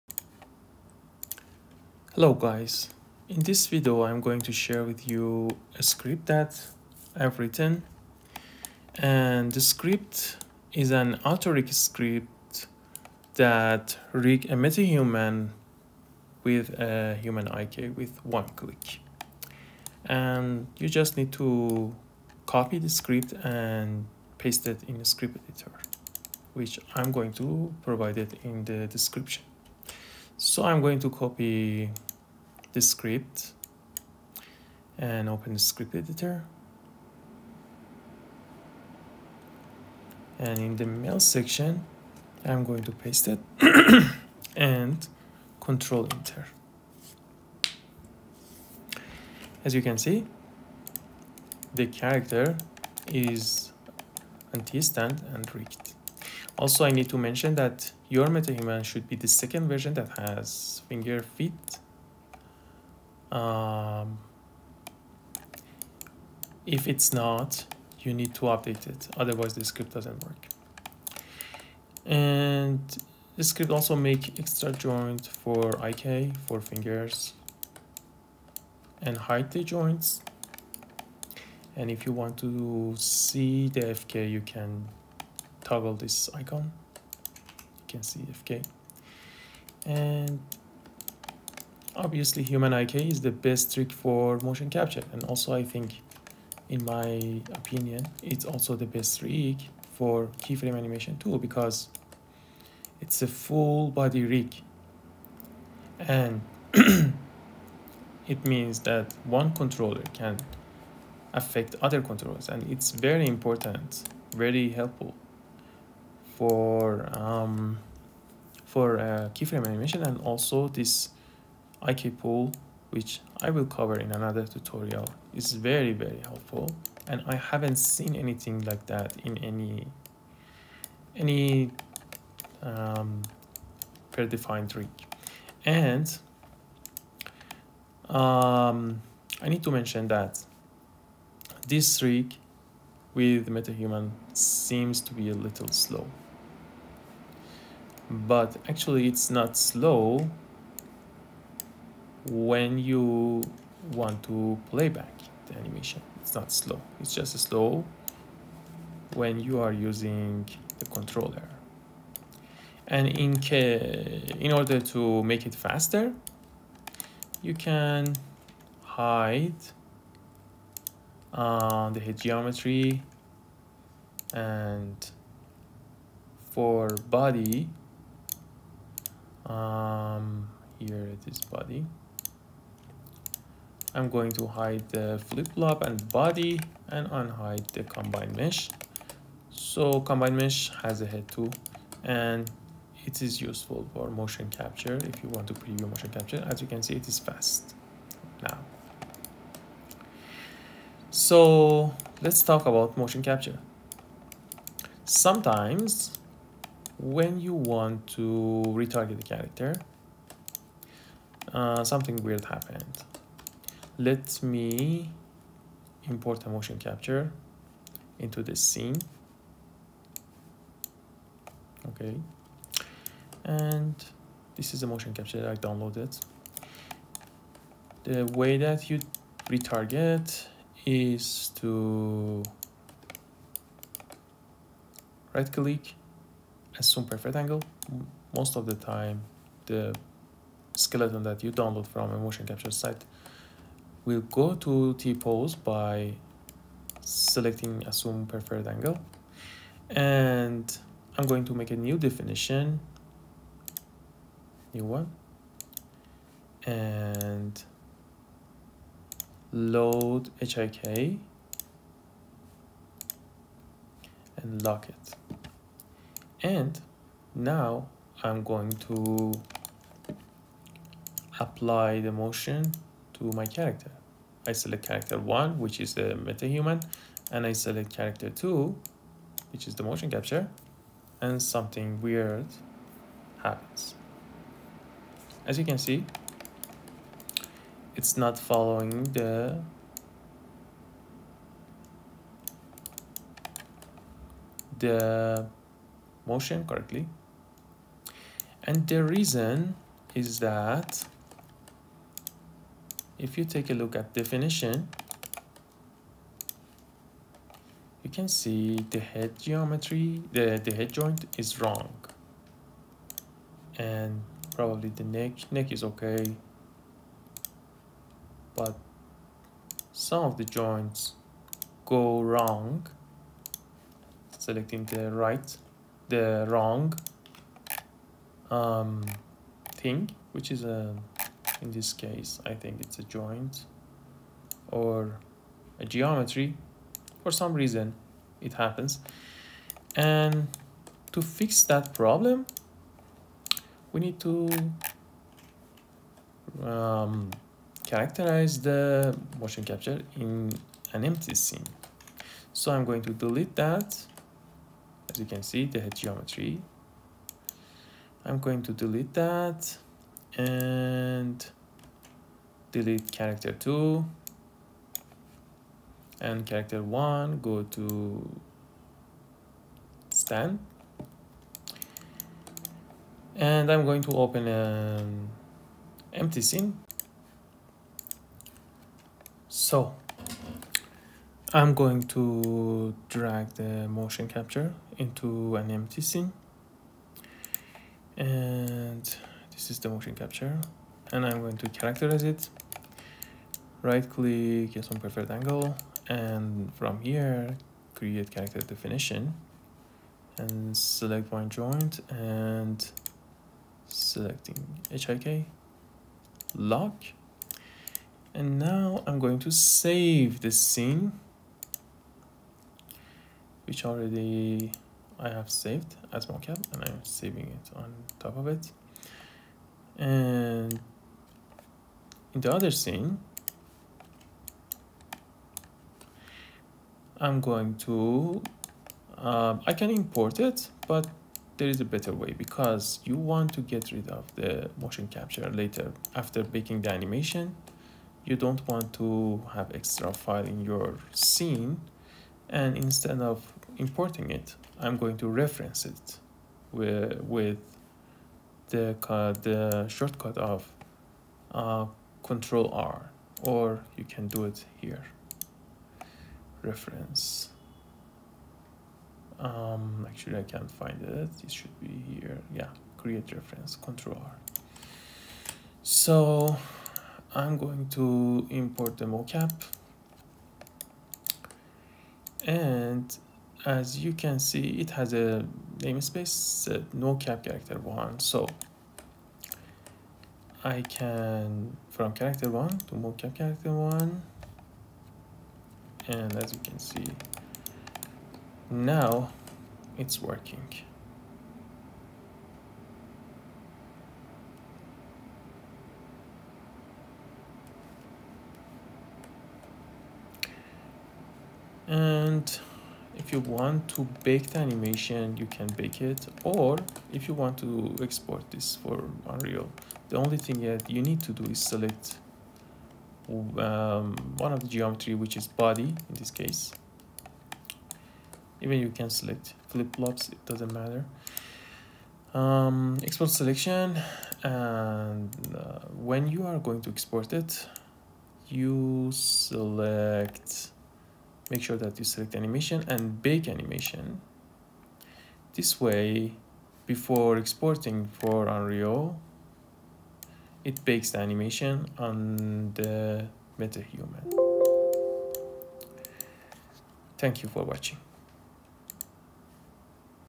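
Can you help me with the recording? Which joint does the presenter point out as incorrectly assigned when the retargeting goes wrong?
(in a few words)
head joint.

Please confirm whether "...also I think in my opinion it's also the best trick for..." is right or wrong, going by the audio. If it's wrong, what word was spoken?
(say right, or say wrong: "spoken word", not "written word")
right.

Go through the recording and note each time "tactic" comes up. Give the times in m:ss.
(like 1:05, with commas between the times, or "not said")
not said.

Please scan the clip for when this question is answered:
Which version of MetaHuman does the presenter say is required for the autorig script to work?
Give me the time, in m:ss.
0:59.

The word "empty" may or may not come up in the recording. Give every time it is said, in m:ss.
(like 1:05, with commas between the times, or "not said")
5:51, 6:16, 6:25.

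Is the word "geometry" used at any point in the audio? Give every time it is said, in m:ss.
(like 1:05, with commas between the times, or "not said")
2:52, 5:09, 5:35, 5:55, 8:34.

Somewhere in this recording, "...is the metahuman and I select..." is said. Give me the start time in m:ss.
4:35.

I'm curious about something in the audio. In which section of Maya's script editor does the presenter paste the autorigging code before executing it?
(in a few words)
MEL.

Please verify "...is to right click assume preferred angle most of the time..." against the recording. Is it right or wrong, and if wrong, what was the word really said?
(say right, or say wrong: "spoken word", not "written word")
right.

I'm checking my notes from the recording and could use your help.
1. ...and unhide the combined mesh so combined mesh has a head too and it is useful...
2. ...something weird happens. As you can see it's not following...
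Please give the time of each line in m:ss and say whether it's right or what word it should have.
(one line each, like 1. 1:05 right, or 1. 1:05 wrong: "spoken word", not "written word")
1. 3:06 right
2. 4:41 right.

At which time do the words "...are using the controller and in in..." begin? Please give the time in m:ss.
2:39.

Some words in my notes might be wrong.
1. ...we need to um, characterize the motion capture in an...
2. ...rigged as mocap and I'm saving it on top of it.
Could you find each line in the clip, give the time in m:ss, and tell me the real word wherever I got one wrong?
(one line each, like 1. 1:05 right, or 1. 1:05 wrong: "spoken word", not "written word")
1. 5:43 right
2. 6:55 wrong: "saved", not "rigged".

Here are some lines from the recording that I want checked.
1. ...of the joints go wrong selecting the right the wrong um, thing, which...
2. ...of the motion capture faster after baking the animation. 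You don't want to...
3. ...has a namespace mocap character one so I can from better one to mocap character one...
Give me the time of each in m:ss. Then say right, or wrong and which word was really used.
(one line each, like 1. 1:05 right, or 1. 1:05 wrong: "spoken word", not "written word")
1. 5:20 right
2. 7:14 wrong: "later", not "faster"
3. 7:54 wrong: "character", not "better".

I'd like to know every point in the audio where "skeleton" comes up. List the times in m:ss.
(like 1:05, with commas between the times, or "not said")
4:00.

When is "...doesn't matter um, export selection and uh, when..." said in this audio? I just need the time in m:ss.
8:40.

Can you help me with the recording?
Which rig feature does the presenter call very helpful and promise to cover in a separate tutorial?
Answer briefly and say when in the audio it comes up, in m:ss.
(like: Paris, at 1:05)
IK pool, at 2:01.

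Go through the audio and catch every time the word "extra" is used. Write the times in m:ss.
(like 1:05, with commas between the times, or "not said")
1:14, 7:19.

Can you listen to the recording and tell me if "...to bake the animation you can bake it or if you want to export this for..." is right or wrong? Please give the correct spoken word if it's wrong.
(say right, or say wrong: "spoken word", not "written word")
right.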